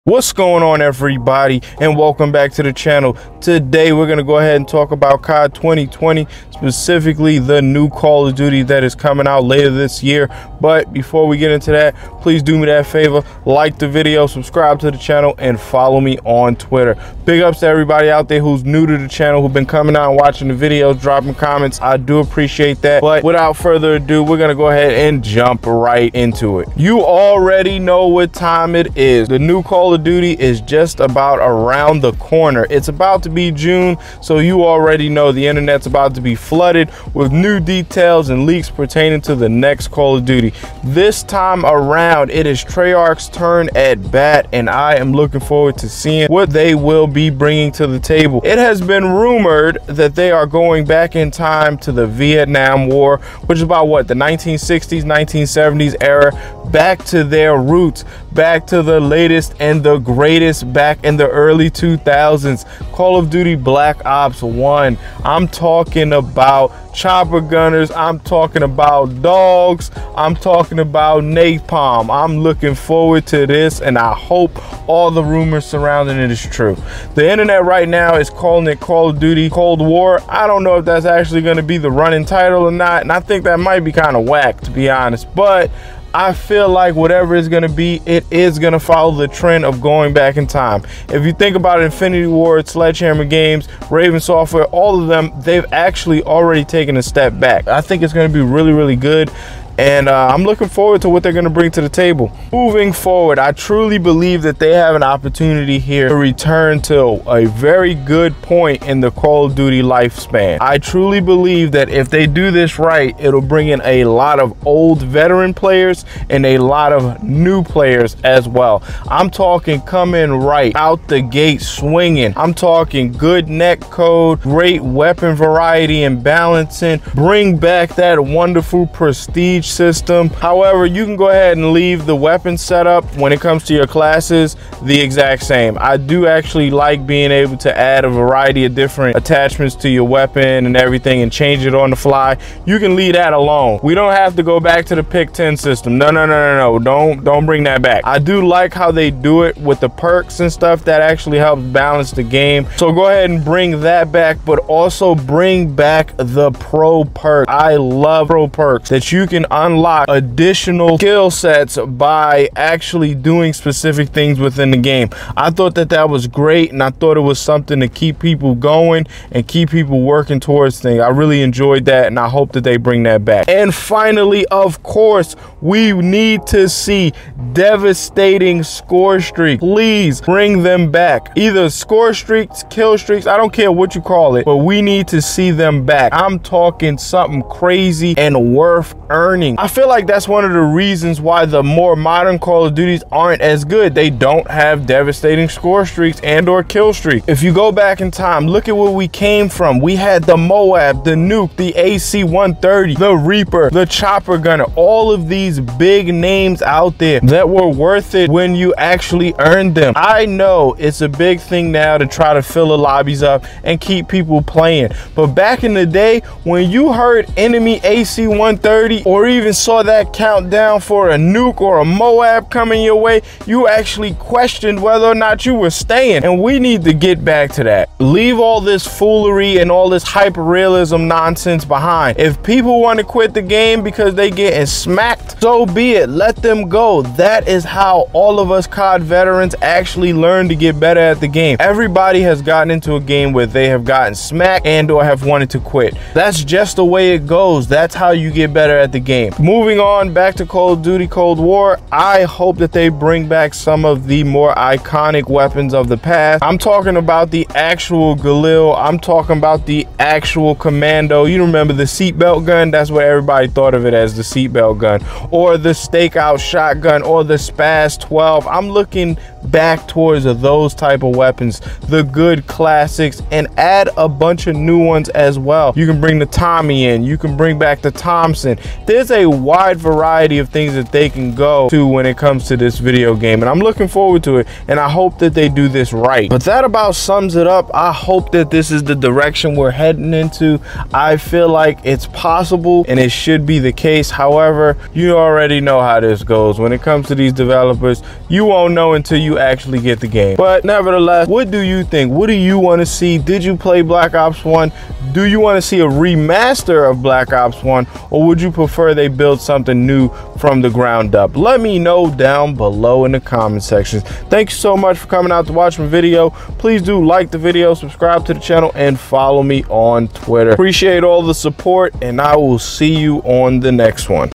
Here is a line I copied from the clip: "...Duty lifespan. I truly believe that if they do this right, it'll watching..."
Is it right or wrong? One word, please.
wrong.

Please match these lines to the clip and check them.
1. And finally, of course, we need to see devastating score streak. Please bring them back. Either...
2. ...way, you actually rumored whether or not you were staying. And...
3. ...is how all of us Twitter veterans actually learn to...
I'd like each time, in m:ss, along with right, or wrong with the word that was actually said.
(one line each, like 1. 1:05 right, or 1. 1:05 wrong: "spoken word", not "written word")
1. 2:53 right
2. 3:42 wrong: "questioned", not "rumored"
3. 3:57 wrong: "COD", not "Twitter".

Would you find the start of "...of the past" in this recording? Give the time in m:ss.
4:15.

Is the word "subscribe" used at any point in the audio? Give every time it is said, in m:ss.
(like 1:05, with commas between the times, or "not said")
0:14, 5:17.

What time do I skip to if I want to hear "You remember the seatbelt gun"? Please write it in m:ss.
4:21.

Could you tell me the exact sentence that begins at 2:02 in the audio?
I'm talking good netcode, great weapon variety and balancing.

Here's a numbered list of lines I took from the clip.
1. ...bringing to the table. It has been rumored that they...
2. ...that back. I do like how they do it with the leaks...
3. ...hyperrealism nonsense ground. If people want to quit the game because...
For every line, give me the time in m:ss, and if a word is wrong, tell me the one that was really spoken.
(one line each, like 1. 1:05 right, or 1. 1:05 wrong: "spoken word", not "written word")
1. 0:47 right
2. 2:27 wrong: "perks", not "leaks"
3. 3:50 wrong: "behind", not "ground".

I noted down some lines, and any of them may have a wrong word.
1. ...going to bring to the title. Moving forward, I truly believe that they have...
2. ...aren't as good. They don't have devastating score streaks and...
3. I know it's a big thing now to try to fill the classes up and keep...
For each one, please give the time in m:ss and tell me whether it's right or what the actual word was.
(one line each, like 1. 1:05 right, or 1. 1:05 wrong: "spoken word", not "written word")
1. 1:41 wrong: "table", not "title"
2. 3:13 right
3. 3:29 wrong: "lobbies", not "classes".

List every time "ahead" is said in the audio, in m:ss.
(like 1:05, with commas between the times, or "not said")
0:04, 0:24, 2:11, 2:33.